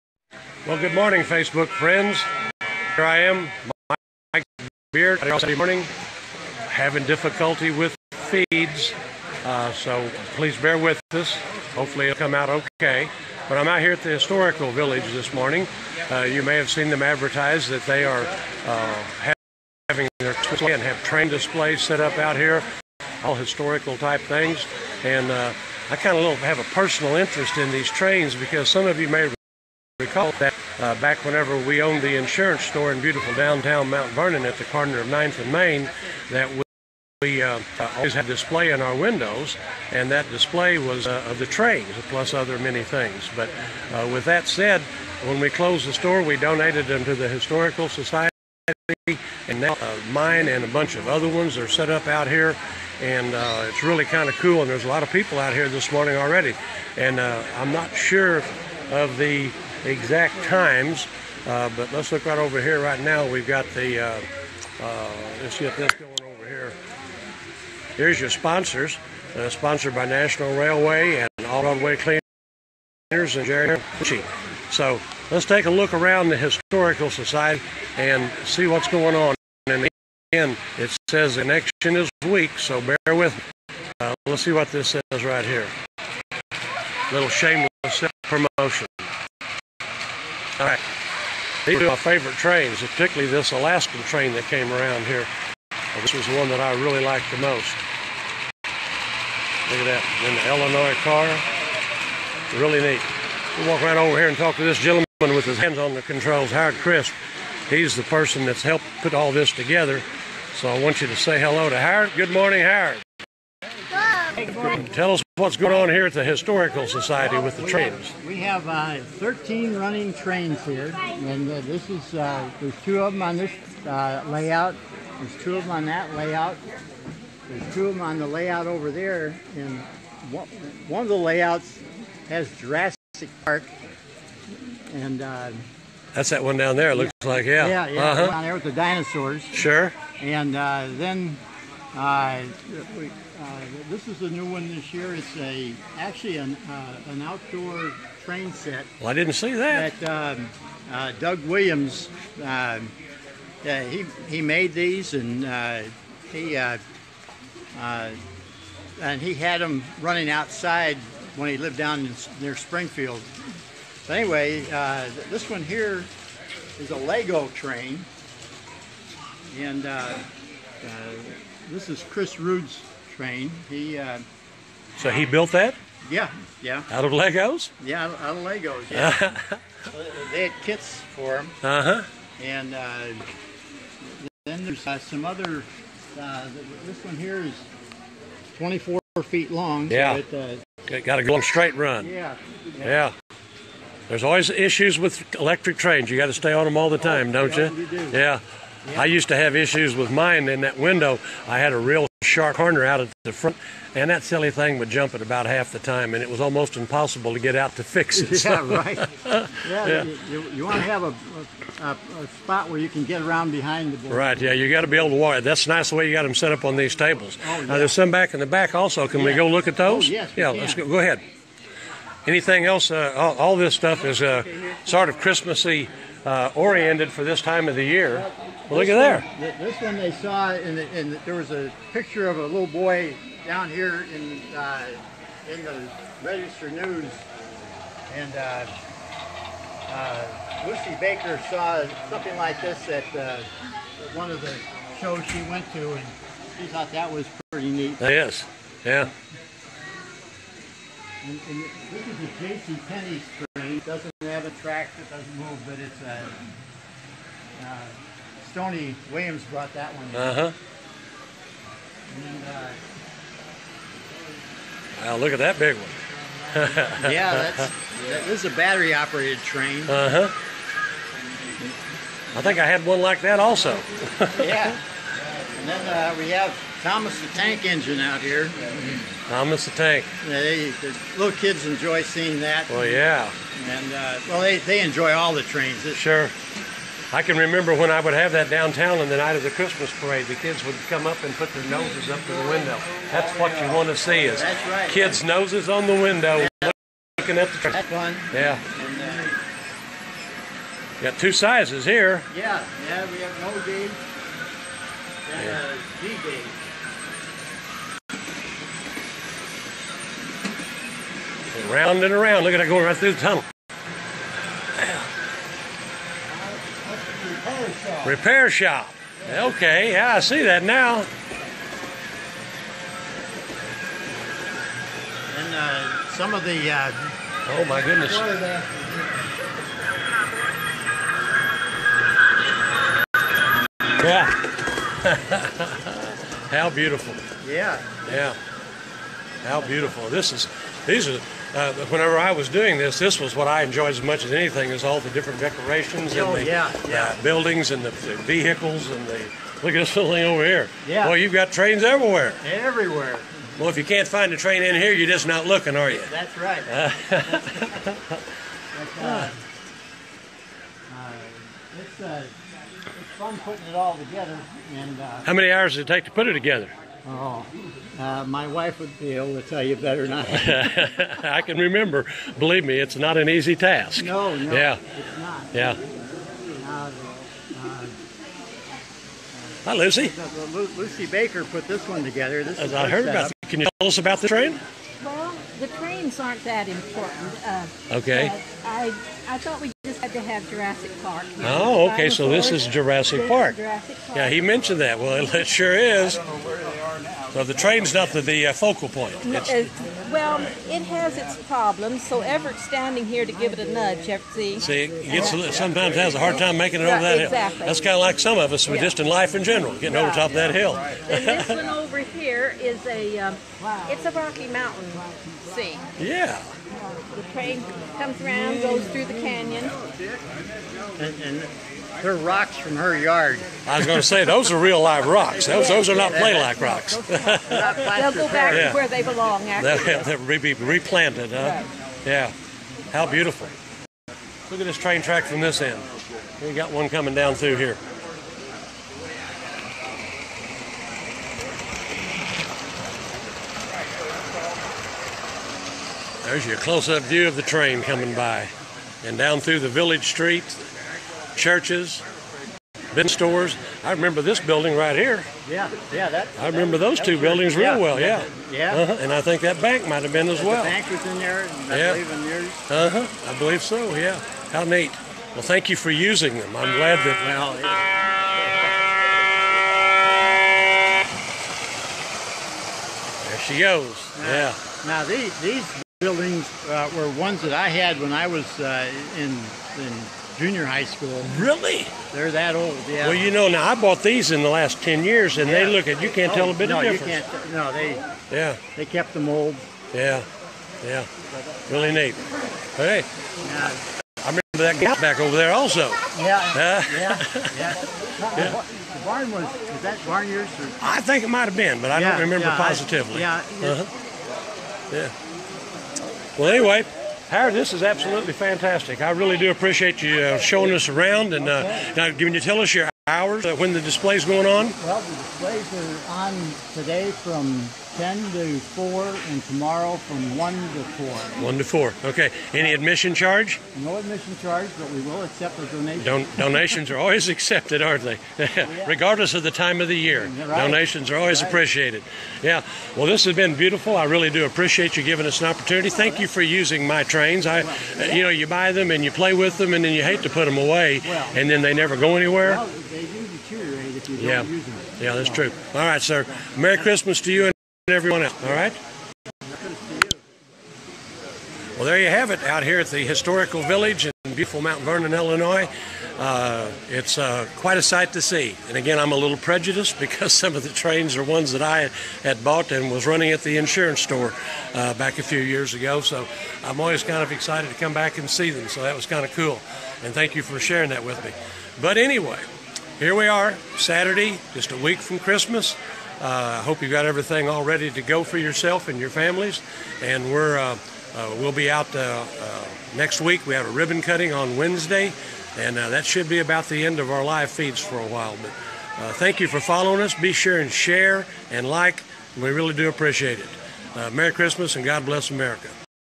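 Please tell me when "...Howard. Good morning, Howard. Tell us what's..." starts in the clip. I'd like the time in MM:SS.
01:51.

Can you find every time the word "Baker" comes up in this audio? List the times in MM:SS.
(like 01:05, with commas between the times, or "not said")
04:01, 06:21.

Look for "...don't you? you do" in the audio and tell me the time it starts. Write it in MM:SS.
03:17.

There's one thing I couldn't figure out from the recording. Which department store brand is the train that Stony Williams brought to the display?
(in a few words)
J.C. Penney.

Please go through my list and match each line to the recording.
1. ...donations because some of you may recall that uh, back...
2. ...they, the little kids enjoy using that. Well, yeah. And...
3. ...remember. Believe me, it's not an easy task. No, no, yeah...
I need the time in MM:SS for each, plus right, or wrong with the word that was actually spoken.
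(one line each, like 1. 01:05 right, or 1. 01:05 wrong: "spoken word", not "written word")
1. 00:27 wrong: "trains", not "donations"
2. 04:40 wrong: "seeing", not "using"
3. 06:11 right.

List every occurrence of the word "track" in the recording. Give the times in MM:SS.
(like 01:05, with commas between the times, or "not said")
04:14, 07:15.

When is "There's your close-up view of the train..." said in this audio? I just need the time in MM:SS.
07:26.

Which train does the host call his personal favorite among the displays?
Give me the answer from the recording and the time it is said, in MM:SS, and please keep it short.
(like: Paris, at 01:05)
Alaskan train, at 01:33.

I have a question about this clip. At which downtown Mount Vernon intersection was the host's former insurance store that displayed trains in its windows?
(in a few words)
9th and Main.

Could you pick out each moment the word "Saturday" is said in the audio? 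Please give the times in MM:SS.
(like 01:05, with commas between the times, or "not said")
00:05, 09:33.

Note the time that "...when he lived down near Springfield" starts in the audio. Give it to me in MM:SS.
02:41.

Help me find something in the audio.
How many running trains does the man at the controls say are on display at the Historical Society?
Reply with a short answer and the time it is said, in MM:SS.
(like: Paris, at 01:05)
13, at 01:59.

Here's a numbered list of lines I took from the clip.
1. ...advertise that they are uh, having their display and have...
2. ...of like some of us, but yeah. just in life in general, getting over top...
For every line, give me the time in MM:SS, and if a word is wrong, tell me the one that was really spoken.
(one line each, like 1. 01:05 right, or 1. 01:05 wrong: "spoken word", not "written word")
1. 00:17 right
2. 06:47 right.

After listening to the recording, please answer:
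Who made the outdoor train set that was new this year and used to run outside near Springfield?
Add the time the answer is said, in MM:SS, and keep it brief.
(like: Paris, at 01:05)
Doug Williams, at 02:31.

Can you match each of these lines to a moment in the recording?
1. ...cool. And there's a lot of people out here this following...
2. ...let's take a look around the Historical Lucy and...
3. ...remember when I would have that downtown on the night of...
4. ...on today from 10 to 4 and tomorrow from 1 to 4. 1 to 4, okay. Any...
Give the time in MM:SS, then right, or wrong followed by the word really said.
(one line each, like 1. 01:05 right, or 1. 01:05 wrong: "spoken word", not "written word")
1. 00:54 wrong: "morning", not "following"
2. 01:15 wrong: "Society", not "Lucy"
3. 04:47 right
4. 08:36 right.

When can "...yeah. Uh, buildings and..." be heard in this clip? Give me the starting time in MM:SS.
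05:46.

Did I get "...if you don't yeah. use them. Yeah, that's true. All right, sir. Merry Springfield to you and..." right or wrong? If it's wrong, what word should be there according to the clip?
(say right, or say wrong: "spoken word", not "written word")
wrong: "Christmas", not "Springfield".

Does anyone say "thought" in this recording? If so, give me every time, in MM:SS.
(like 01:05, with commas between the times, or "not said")
04:06, 06:29.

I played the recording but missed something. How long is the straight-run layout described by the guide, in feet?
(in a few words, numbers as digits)
24 feet.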